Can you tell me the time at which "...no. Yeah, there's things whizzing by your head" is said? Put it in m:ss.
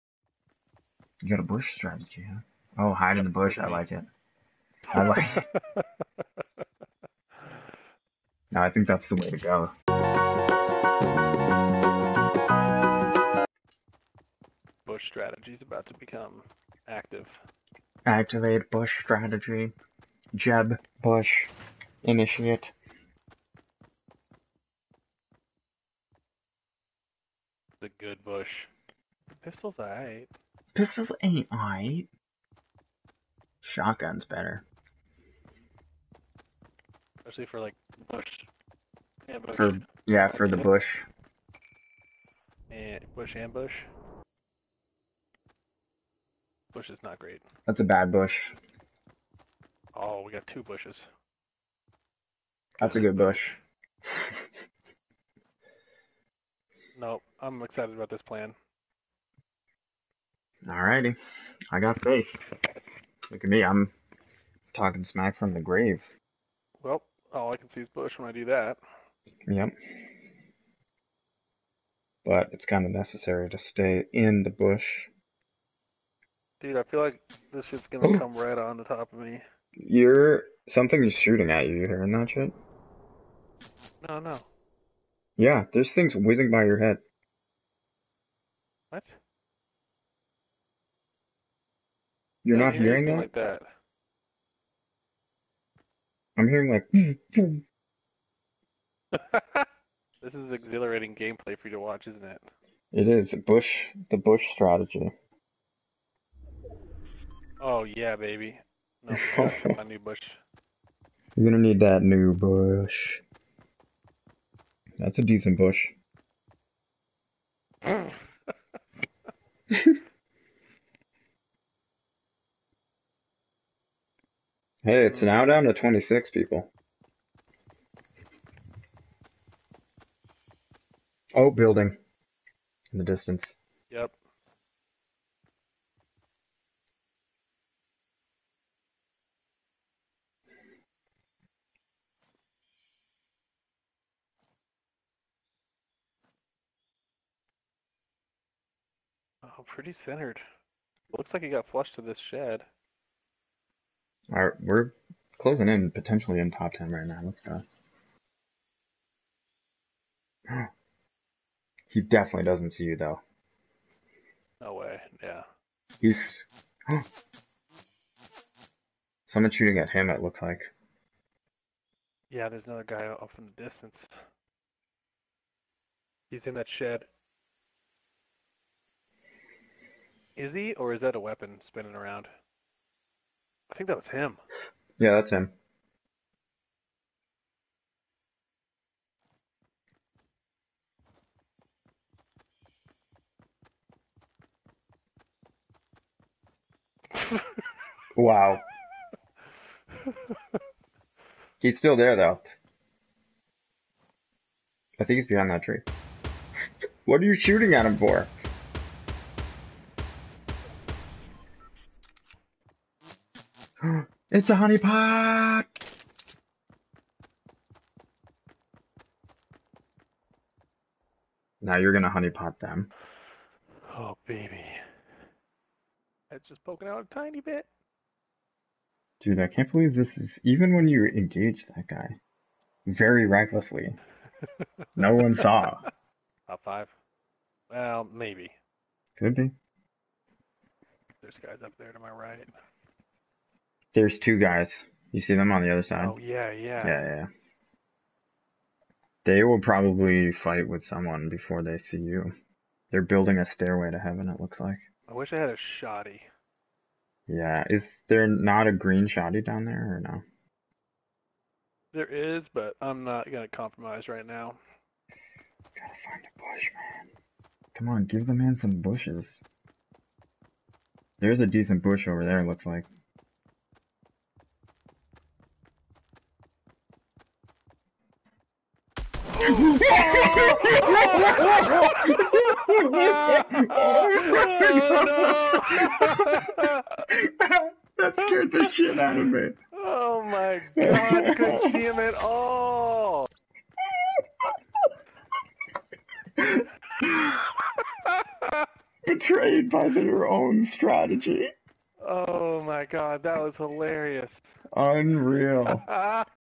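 1:24.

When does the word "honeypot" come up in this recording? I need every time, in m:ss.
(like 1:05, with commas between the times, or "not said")
3:34, 3:42.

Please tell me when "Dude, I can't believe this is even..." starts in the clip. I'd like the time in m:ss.
3:49.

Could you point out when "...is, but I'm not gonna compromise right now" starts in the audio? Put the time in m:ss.
4:22.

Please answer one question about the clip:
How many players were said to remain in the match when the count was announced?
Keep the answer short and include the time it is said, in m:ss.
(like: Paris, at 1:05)
26, at 2:05.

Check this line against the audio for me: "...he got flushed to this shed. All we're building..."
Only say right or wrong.
wrong.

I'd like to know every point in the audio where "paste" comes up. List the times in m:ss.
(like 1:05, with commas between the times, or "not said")
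not said.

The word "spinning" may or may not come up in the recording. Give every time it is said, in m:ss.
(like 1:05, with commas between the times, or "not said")
3:01.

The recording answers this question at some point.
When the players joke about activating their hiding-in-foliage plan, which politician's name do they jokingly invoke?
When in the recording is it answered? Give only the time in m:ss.
0:20.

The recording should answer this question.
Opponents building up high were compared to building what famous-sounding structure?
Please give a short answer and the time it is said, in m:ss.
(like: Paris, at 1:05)
stairway to heaven, at 4:13.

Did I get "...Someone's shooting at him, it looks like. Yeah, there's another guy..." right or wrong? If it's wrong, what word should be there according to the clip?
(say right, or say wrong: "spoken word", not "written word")
right.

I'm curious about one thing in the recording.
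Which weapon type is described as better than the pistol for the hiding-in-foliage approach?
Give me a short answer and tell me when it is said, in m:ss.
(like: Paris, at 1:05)
Shotgun, at 0:33.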